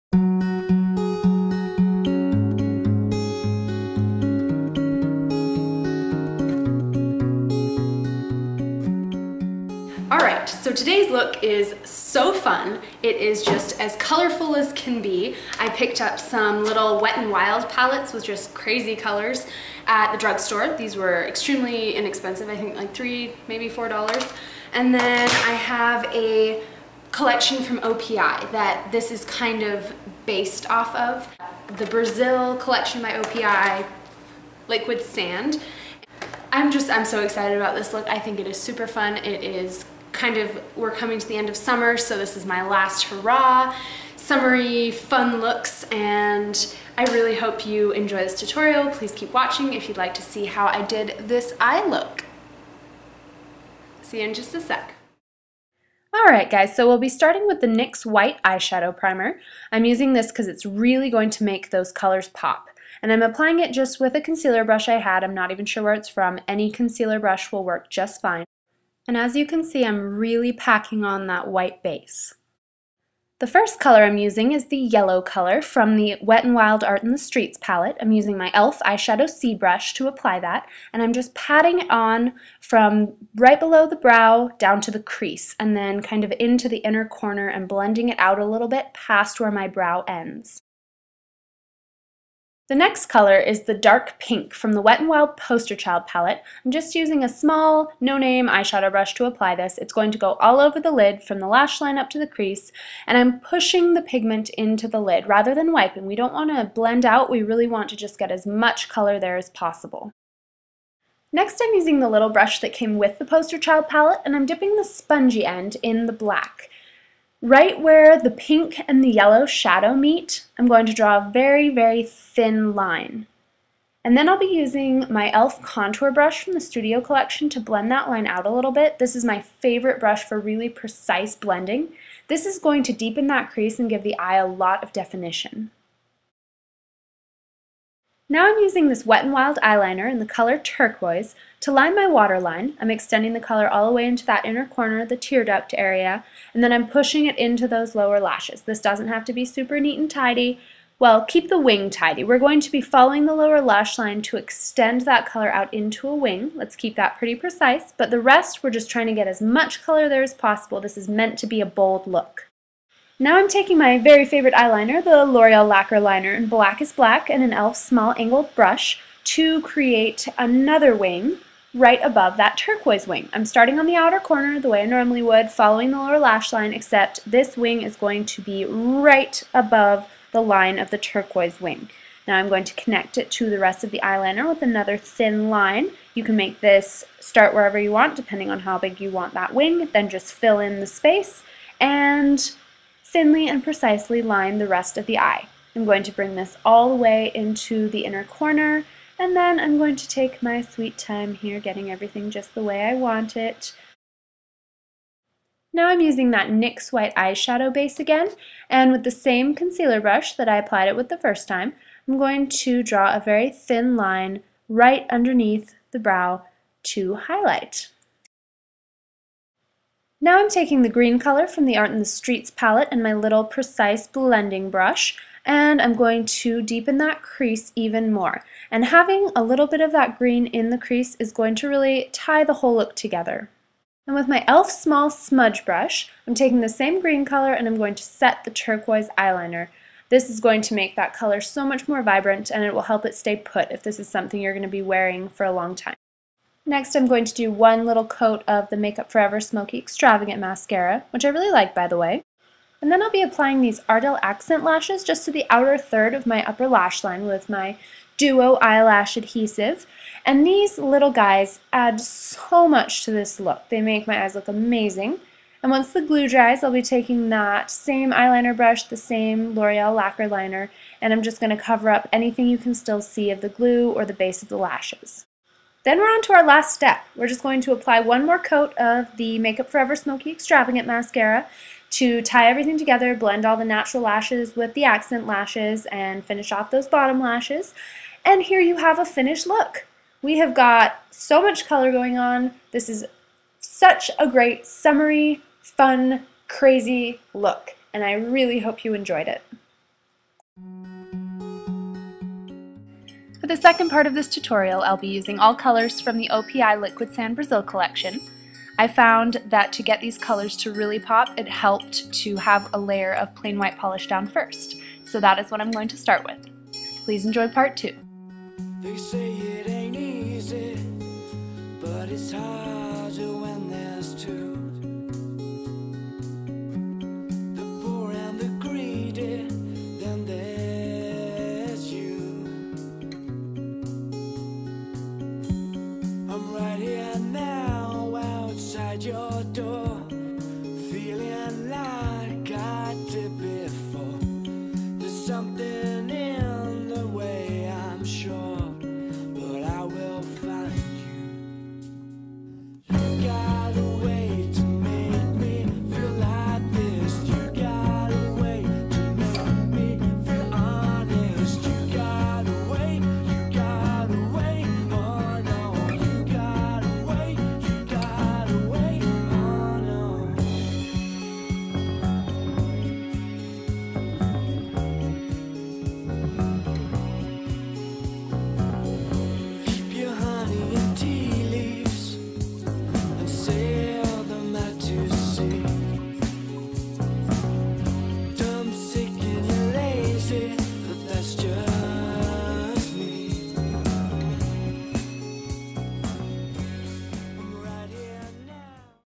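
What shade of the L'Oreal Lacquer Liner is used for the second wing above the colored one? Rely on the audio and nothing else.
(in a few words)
Black is Black.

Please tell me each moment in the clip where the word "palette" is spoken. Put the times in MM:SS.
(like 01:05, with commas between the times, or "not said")
00:17, 01:17, 01:36, 01:53, 03:42.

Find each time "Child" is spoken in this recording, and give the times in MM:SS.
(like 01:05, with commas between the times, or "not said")
01:35, 01:53.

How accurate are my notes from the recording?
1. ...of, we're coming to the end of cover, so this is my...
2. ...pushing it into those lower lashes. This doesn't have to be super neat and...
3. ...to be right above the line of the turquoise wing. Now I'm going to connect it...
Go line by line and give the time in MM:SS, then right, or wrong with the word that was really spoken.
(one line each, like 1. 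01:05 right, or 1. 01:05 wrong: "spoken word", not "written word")
1. 00:40 wrong: "summer", not "cover"
2. 02:26 right
3. 02:58 right.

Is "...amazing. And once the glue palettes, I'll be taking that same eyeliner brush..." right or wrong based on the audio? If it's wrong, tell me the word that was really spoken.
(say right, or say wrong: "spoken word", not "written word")
wrong: "dries", not "palettes".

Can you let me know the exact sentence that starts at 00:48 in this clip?
Please keep watching if you'd like to see how I did this eye look.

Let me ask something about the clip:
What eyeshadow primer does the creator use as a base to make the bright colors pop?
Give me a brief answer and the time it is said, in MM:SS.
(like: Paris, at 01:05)
NYX White Eyeshadow Primer, at 00:57.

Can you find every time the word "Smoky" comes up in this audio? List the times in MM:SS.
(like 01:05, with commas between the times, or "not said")
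04:09, 04:39.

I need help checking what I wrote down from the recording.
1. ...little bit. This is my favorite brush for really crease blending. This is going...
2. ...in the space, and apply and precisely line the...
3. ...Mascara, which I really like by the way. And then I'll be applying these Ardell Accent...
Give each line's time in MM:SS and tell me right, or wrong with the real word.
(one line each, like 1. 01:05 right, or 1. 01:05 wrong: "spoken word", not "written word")
1. 02:08 wrong: "precise", not "crease"
2. 03:10 wrong: "thinly", not "apply"
3. 04:10 right.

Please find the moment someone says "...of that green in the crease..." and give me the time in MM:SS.
03:49.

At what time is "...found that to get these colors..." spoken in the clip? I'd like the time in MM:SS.
05:08.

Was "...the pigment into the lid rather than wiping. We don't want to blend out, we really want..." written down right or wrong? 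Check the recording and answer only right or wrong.
right.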